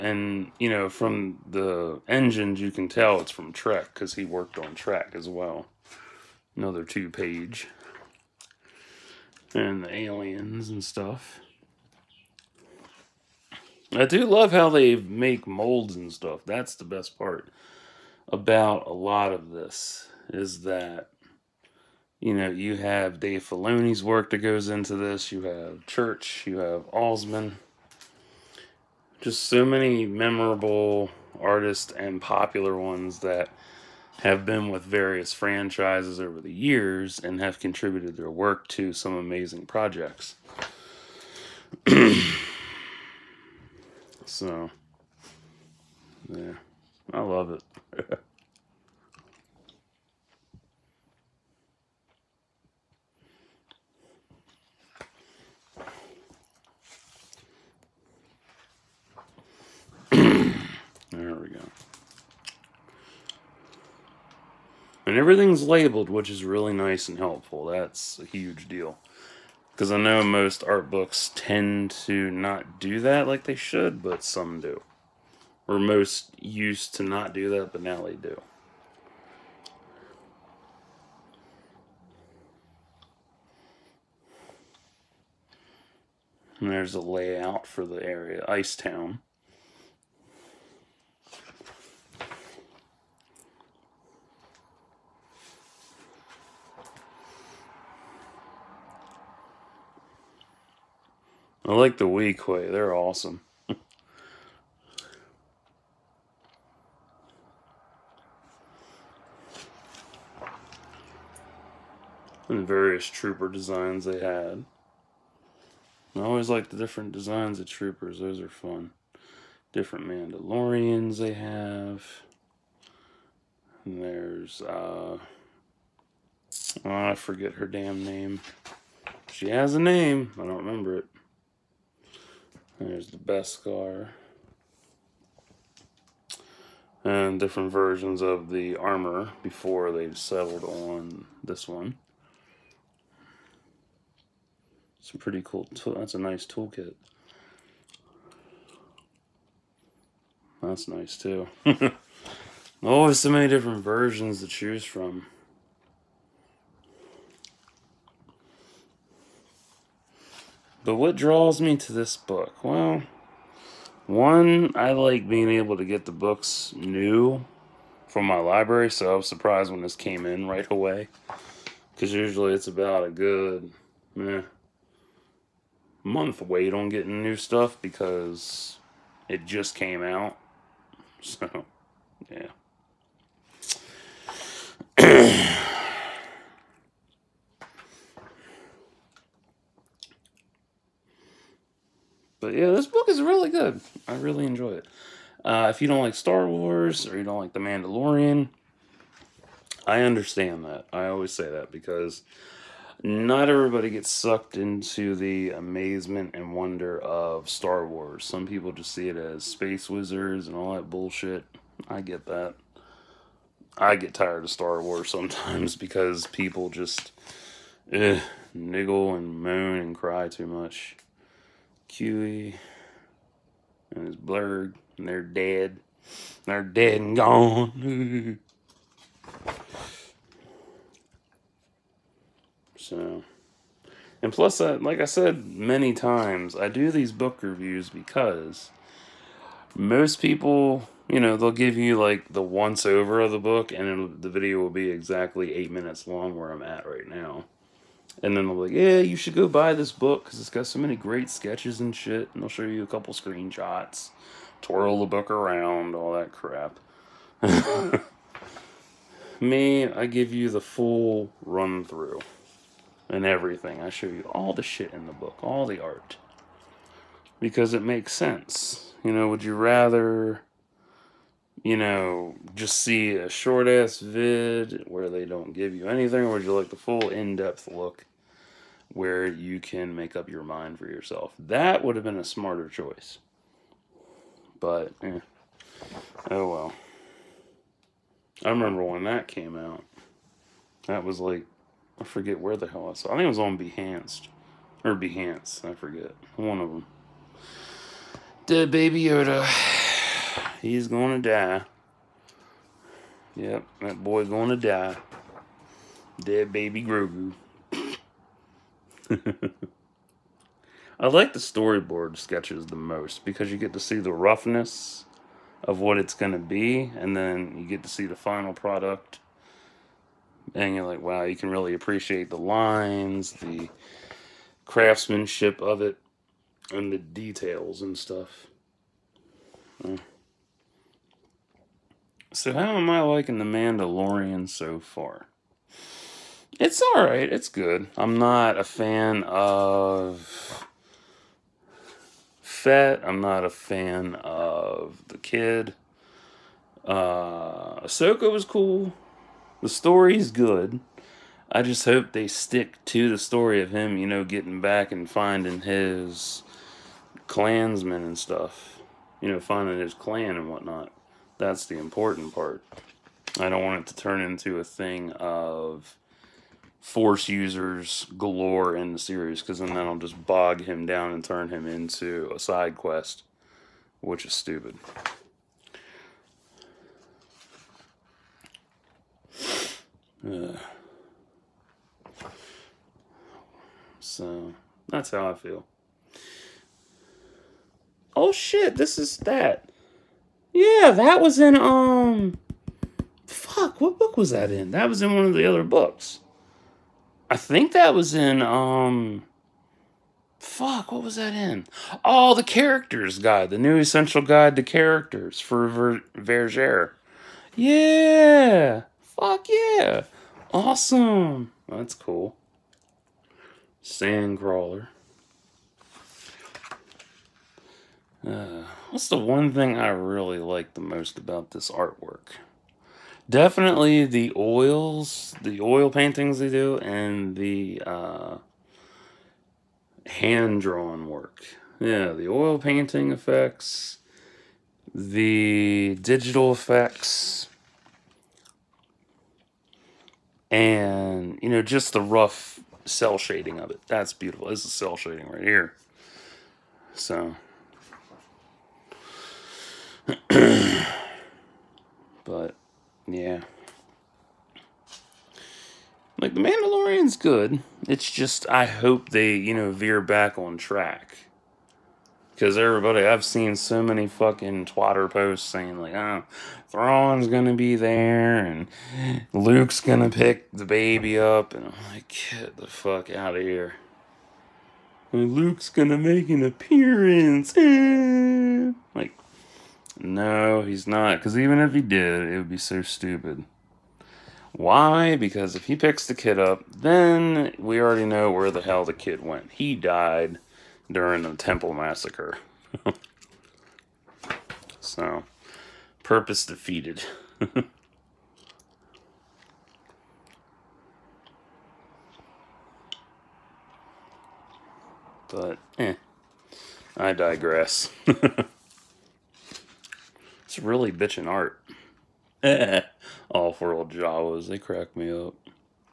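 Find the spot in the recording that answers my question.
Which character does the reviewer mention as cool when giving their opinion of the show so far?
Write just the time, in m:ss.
5:47.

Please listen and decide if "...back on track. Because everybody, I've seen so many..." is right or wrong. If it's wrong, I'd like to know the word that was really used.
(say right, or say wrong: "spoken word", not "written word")
right.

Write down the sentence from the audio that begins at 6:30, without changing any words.
Yeah, that was in um fuck, what book was that in?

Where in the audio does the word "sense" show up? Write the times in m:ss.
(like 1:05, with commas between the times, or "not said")
4:28.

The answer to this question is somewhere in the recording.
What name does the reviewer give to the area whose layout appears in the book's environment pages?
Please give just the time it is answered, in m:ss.
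1:28.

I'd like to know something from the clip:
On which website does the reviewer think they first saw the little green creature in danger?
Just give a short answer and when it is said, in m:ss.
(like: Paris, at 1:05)
Behance, at 4:54.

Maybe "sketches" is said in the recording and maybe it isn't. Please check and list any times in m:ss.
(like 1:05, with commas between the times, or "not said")
4:11, 5:12.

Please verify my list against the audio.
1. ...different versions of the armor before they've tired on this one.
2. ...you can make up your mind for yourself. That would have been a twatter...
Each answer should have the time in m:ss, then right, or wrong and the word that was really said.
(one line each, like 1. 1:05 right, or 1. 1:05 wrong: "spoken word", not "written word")
1. 2:17 wrong: "settled", not "tired"
2. 4:39 wrong: "smarter", not "twatter".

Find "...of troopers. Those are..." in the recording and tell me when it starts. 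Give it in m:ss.
1:57.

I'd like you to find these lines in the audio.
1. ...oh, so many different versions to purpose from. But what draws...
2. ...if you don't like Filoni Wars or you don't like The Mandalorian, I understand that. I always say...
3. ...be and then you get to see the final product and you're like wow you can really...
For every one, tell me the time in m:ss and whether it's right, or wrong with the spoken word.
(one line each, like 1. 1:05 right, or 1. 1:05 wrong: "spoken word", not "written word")
1. 2:32 wrong: "choose", not "purpose"
2. 3:15 wrong: "Star", not "Filoni"
3. 5:16 right.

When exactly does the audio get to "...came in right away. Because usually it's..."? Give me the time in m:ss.
2:49.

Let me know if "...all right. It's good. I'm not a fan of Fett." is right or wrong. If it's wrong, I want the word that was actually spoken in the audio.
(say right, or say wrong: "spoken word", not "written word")
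right.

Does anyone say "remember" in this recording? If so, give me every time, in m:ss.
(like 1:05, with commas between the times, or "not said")
2:10, 4:48.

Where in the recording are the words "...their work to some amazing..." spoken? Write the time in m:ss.
0:38.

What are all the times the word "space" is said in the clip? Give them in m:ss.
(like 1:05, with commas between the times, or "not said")
3:29.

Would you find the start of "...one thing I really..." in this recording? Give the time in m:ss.
6:59.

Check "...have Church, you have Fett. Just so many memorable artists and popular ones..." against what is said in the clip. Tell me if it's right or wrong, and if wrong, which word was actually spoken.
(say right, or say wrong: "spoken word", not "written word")
wrong: "Alsman", not "Fett".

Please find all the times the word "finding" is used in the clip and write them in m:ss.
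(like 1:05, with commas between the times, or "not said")
5:55, 5:59.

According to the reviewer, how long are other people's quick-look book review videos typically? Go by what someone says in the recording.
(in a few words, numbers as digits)
8 minutes.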